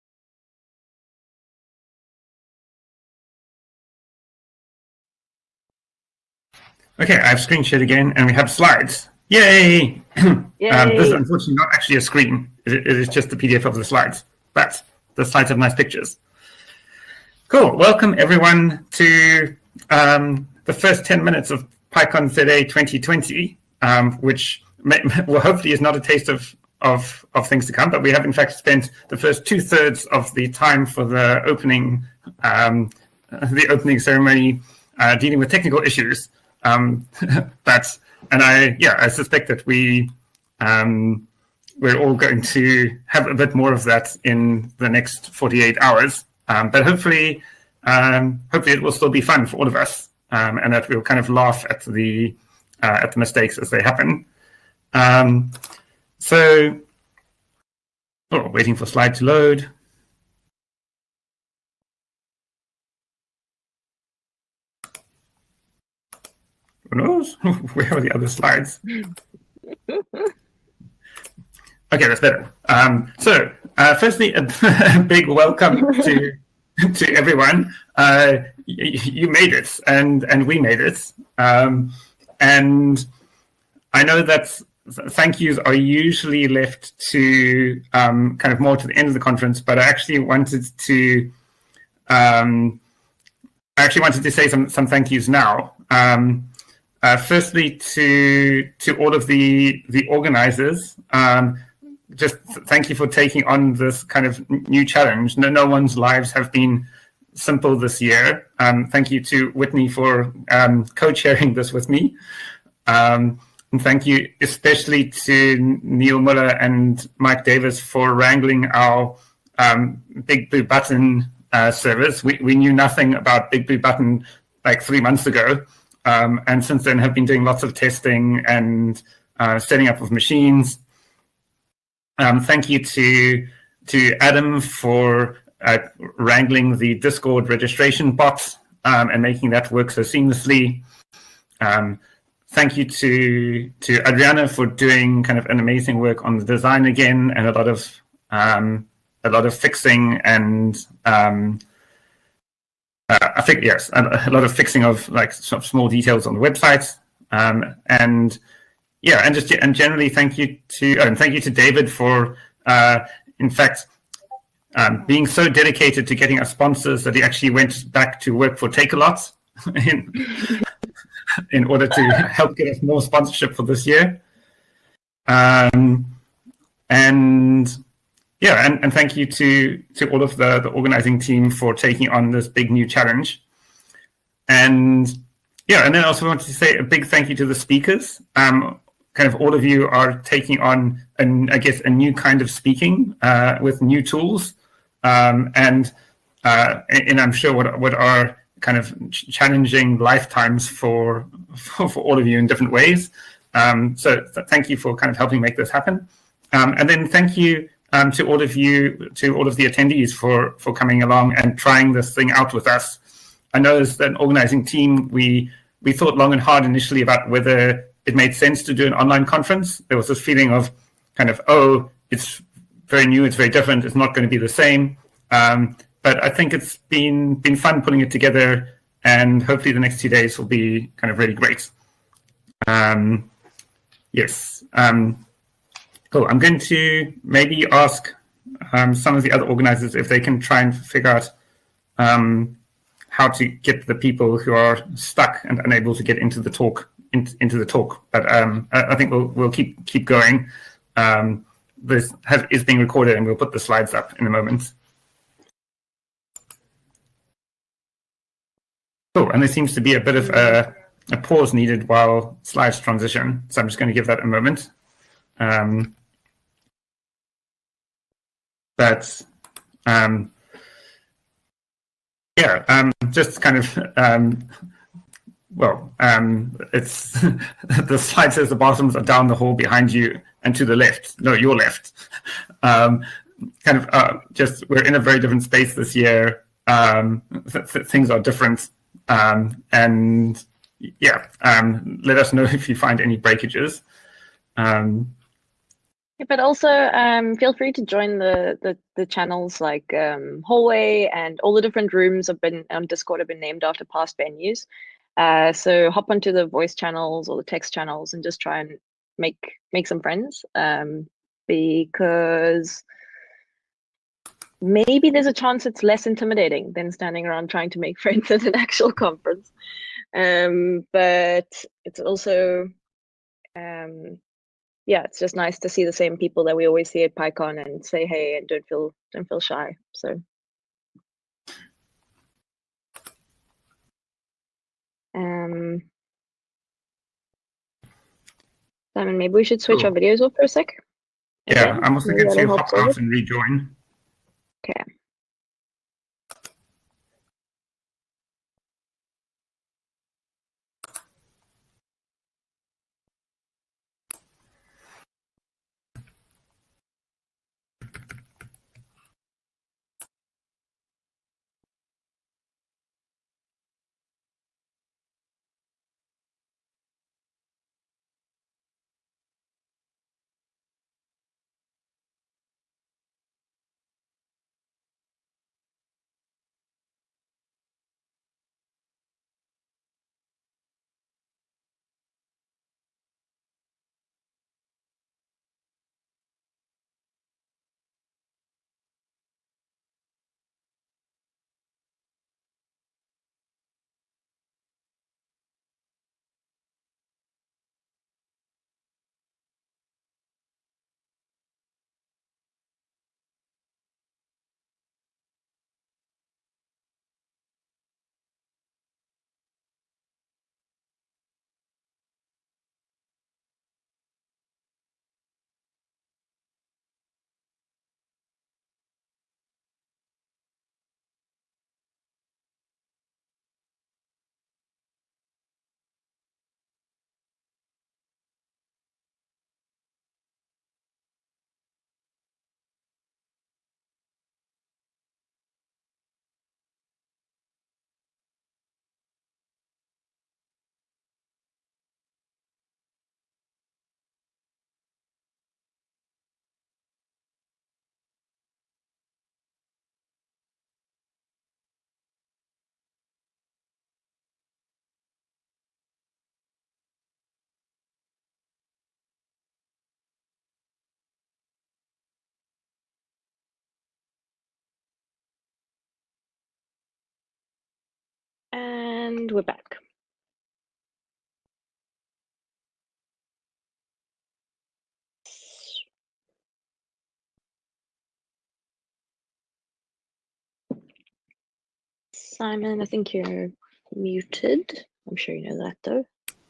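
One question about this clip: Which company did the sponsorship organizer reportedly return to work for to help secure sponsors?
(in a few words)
Takealot.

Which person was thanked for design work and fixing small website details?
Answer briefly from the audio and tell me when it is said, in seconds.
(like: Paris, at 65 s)
Adriana, at 144 s.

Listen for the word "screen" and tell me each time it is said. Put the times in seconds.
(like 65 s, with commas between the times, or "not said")
7 s, 12 s.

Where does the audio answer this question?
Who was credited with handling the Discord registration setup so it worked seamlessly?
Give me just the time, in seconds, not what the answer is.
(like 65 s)
134 s.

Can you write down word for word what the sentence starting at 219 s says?
There was this feeling of kind of, oh, it's very new, it's very different, it's not going to be the same.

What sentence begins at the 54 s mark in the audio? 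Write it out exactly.
Um, so, oh, waiting for slide to load.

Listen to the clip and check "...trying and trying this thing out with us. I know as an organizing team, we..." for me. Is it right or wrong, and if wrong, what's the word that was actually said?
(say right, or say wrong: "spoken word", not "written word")
wrong: "along", not "trying".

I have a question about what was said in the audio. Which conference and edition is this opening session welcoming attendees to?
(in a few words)
PyCon ZA 2020.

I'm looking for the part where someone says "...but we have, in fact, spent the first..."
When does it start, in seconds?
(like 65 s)
27 s.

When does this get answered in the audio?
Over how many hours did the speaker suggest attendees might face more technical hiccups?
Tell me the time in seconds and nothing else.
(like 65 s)
45 s.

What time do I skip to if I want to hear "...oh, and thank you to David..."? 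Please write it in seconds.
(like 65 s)
160 s.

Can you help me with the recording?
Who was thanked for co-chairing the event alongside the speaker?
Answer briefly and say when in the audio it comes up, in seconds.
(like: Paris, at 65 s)
Whitney, at 109 s.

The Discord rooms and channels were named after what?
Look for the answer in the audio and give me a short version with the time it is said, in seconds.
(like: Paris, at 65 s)
past venues, at 303 s.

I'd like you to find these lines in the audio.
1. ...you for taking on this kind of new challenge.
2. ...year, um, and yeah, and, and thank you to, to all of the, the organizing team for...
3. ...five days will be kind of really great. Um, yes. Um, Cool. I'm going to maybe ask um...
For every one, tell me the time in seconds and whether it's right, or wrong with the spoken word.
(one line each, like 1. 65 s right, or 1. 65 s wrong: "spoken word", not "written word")
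1. 102 s right
2. 173 s right
3. 230 s wrong: "two", not "five".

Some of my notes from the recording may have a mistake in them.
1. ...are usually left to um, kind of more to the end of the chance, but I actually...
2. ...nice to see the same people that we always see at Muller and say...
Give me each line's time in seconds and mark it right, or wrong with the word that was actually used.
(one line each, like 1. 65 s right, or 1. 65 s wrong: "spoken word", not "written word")
1. 85 s wrong: "conference", not "chance"
2. 325 s wrong: "PyCon", not "Muller".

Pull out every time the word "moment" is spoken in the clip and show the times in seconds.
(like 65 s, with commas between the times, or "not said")
254 s, 264 s.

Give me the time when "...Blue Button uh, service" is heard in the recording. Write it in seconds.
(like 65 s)
120 s.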